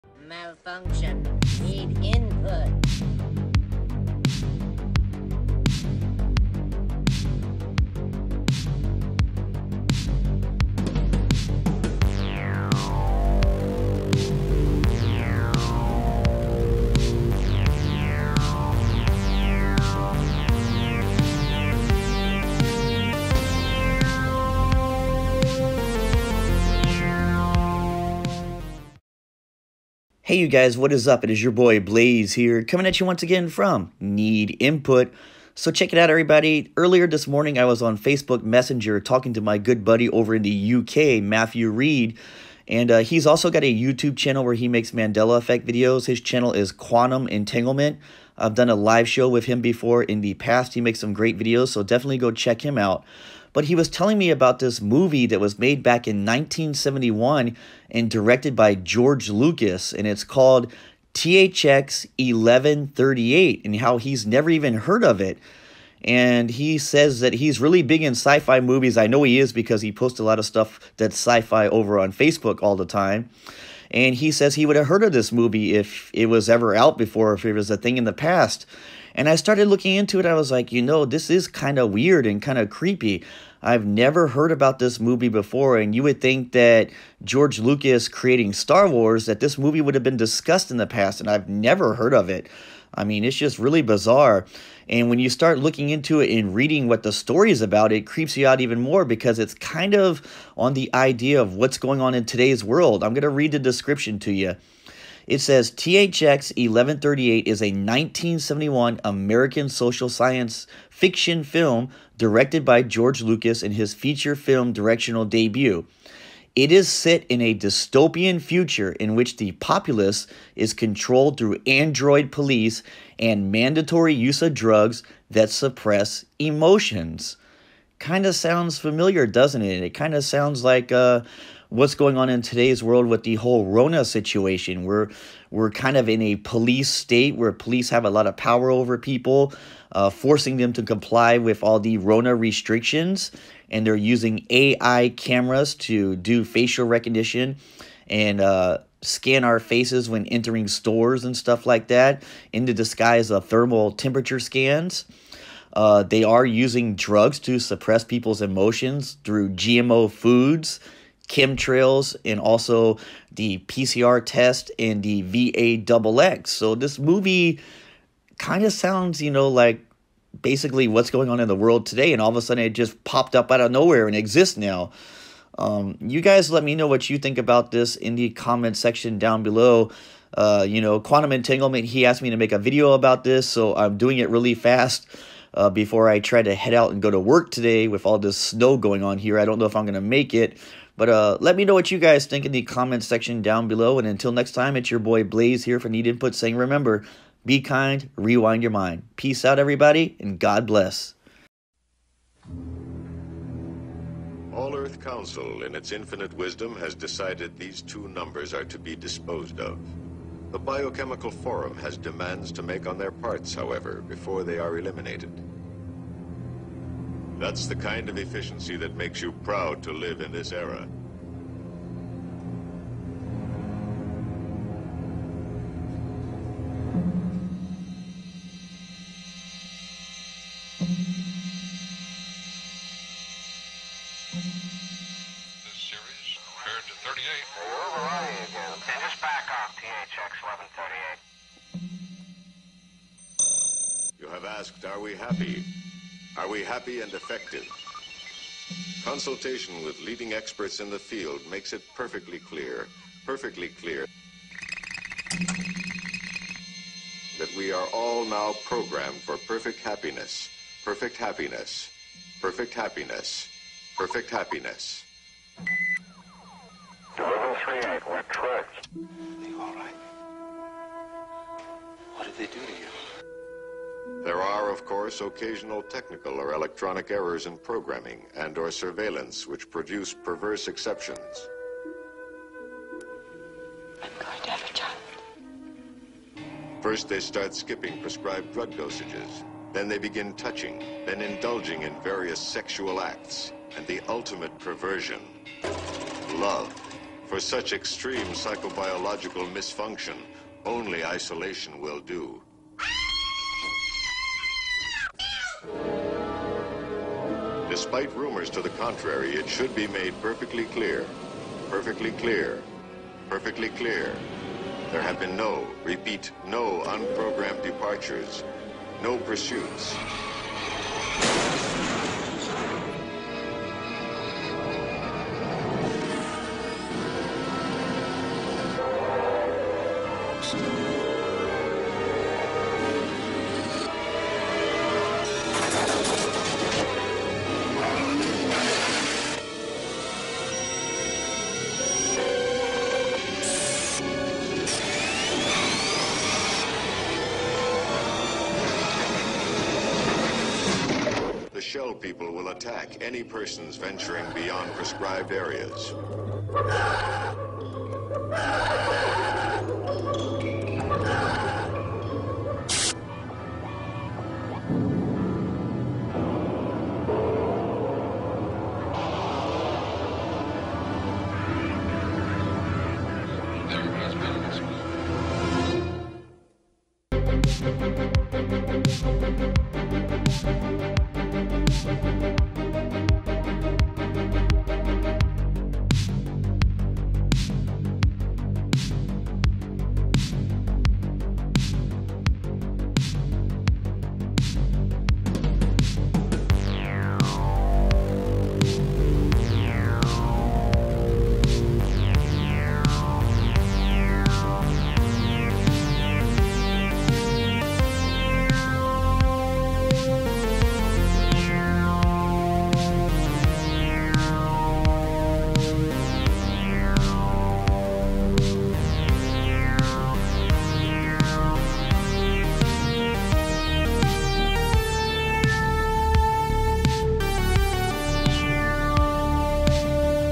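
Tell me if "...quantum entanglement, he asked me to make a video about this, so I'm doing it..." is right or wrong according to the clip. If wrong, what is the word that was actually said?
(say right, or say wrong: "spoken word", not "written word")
right.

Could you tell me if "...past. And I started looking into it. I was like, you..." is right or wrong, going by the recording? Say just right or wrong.
right.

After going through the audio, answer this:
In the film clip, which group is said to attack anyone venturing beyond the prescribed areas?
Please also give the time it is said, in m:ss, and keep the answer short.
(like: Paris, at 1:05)
the shell people, at 5:51.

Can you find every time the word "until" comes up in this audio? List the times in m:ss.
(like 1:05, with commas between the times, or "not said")
3:14.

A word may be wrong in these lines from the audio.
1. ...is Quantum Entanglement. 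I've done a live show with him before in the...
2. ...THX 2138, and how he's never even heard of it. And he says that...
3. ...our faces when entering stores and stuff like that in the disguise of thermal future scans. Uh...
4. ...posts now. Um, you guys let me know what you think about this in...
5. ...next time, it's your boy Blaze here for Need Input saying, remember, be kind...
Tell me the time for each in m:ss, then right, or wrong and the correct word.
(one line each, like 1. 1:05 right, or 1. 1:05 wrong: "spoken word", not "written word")
1. 0:46 right
2. 1:01 wrong: "1138", not "2138"
3. 2:29 wrong: "temperature", not "future"
4. 2:54 wrong: "exists", not "posts"
5. 3:14 right.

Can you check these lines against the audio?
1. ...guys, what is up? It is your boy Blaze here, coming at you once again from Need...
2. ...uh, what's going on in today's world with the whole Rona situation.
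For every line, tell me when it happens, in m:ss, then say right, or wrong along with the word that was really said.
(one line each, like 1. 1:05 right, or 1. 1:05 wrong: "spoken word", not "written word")
1. 0:30 right
2. 2:10 right.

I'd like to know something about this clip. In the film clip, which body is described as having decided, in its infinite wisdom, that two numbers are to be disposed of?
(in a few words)
All Earth Council.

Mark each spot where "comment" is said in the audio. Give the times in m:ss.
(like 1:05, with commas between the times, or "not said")
2:58, 3:12.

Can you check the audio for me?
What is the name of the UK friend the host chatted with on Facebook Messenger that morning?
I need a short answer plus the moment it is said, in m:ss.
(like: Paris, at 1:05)
Matthew Reed, at 0:41.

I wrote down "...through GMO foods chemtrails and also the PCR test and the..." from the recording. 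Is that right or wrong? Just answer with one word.
right.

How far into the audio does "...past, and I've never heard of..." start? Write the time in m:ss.
1:30.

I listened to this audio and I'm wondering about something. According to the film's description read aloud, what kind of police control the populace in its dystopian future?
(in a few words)
android police.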